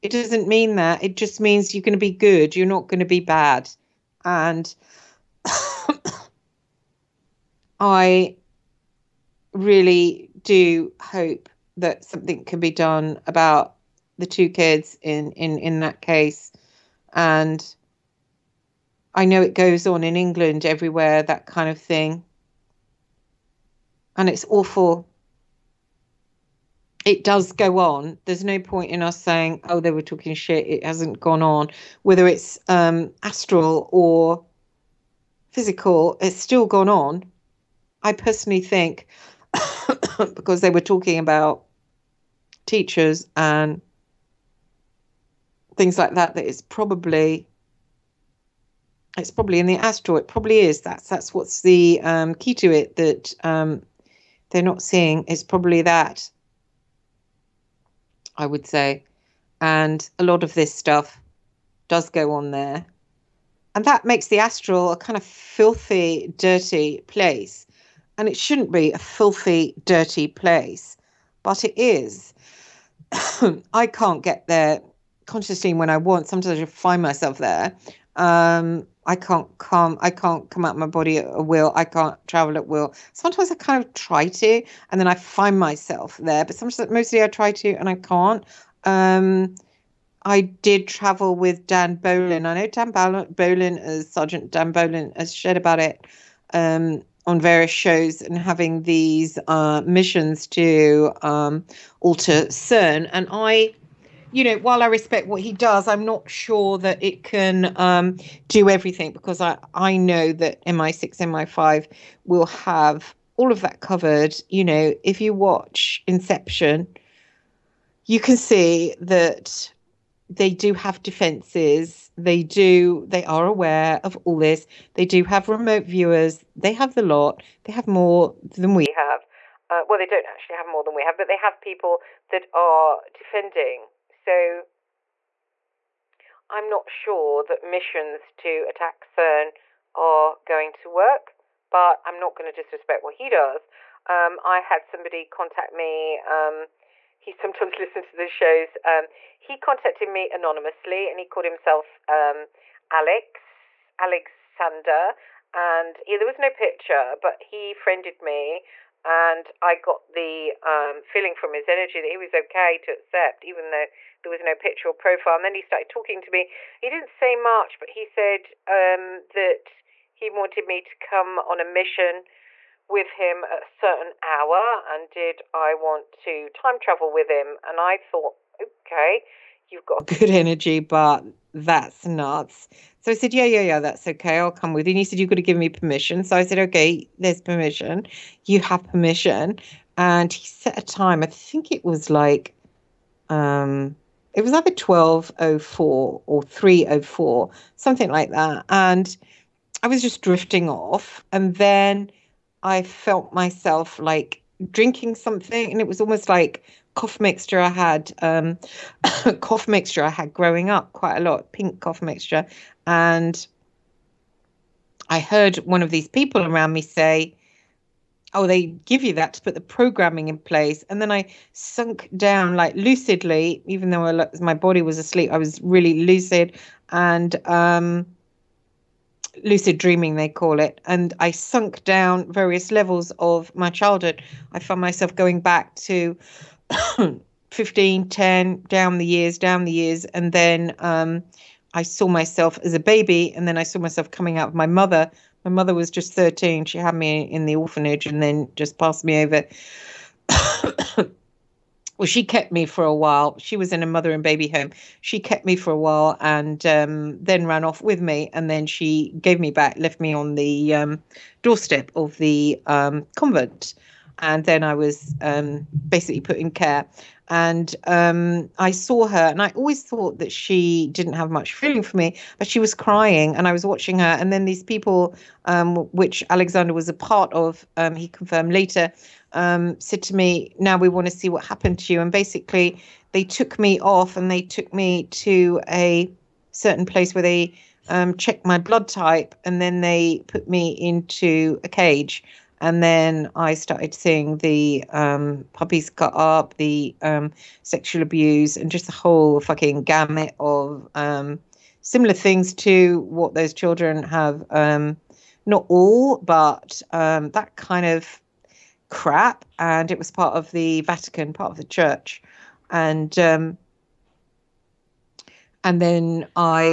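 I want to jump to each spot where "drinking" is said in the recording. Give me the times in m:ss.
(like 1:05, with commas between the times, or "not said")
3:24.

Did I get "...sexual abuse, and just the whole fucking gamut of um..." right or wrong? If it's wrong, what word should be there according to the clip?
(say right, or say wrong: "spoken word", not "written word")
right.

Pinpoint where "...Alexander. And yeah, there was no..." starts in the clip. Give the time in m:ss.
2:33.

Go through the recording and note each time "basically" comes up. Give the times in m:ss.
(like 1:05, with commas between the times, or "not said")
4:25, 4:42.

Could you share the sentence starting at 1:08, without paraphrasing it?
And it shouldn't be a filthy, dirty place, but it is.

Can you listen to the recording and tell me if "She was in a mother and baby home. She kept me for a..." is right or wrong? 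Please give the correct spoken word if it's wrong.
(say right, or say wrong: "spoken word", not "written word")
right.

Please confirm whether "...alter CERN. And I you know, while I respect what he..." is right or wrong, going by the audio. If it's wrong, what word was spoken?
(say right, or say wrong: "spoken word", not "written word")
right.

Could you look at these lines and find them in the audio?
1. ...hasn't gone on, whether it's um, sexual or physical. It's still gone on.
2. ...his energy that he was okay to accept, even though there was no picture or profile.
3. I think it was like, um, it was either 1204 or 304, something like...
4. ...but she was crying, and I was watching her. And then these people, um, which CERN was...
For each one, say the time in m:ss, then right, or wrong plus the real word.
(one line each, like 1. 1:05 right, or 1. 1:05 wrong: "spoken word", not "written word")
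1. 0:30 wrong: "astral", not "sexual"
2. 2:41 right
3. 3:11 right
4. 4:32 wrong: "Alexander", not "CERN".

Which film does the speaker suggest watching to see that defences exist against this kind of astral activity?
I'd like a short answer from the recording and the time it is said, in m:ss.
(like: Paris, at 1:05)
Inception, at 1:56.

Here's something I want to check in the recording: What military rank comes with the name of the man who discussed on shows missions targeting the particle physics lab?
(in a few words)
Sergeant.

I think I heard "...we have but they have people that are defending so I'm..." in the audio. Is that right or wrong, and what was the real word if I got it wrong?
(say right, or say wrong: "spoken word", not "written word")
right.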